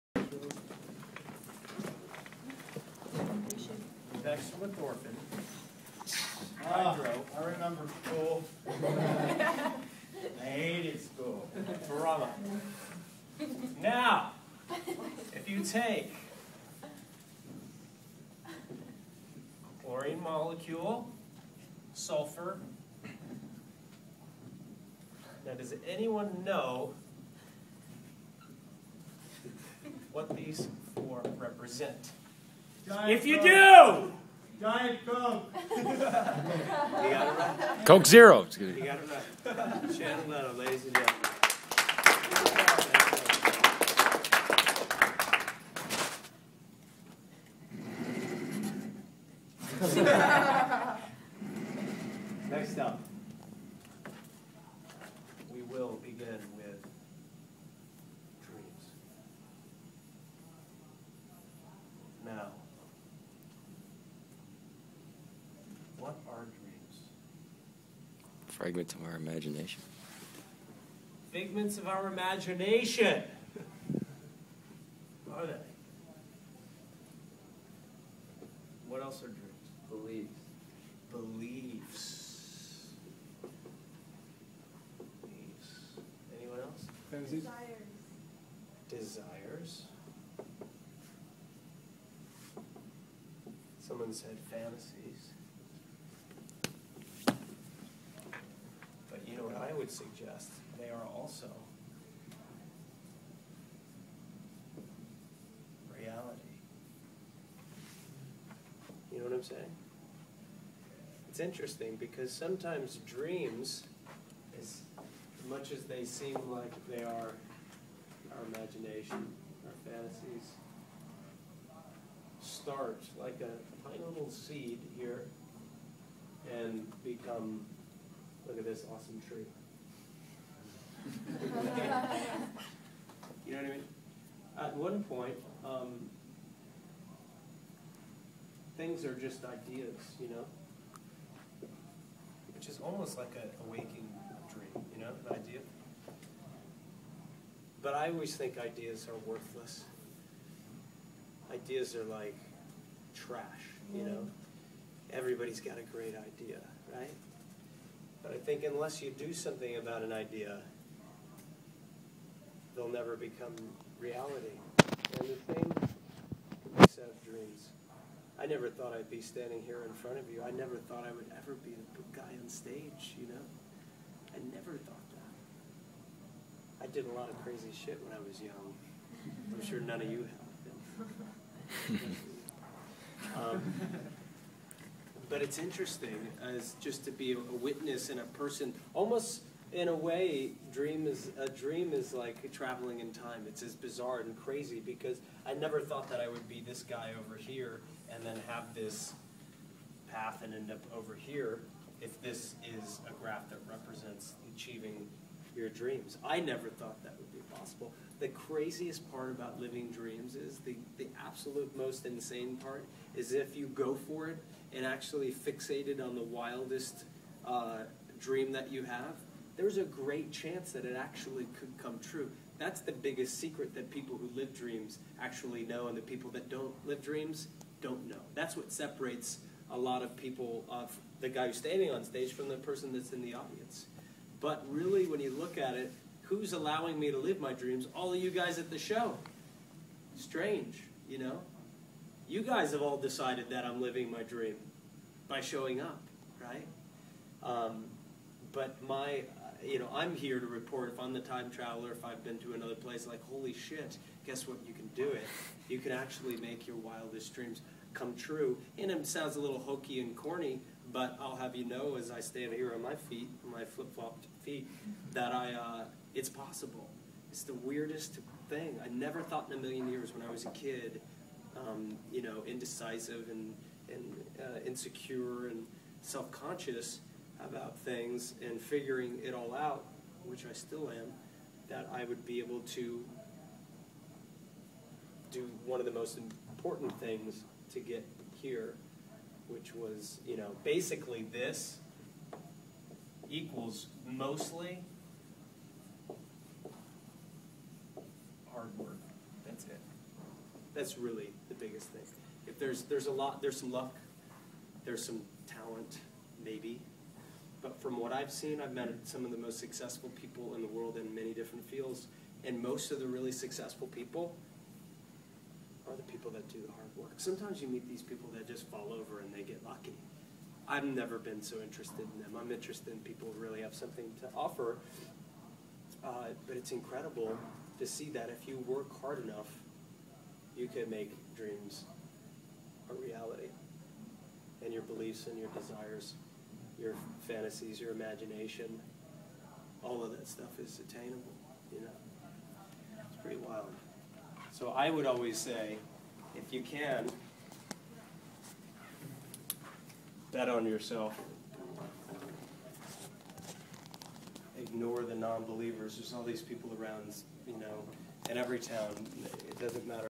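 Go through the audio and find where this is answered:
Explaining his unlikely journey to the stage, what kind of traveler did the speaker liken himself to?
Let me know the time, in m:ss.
4:11.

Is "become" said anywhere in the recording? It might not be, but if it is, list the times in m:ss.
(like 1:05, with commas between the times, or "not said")
2:07, 2:43.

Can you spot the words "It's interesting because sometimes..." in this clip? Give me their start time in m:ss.
1:51.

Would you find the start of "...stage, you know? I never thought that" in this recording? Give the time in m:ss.
2:52.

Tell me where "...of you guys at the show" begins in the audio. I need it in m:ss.
3:58.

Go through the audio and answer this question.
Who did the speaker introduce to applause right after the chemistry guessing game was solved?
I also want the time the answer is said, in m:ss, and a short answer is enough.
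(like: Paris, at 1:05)
Shannon Leto, at 0:39.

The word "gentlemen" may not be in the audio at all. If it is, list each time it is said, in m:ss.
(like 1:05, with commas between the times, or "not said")
0:40.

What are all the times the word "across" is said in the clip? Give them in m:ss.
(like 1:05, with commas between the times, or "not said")
not said.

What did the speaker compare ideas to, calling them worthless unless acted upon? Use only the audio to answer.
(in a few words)
trash.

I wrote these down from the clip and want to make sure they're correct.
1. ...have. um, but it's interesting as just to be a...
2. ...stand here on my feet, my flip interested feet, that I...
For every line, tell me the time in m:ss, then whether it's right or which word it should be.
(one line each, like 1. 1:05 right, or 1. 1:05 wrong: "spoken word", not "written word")
1. 3:01 right
2. 4:22 wrong: "flopped", not "interested".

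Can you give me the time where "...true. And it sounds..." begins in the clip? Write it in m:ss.
4:18.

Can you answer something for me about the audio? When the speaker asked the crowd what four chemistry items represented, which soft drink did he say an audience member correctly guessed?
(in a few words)
Coke Zero.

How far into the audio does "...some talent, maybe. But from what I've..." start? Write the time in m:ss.
5:05.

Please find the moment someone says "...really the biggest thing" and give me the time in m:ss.
5:00.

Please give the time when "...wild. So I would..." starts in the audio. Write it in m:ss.
5:43.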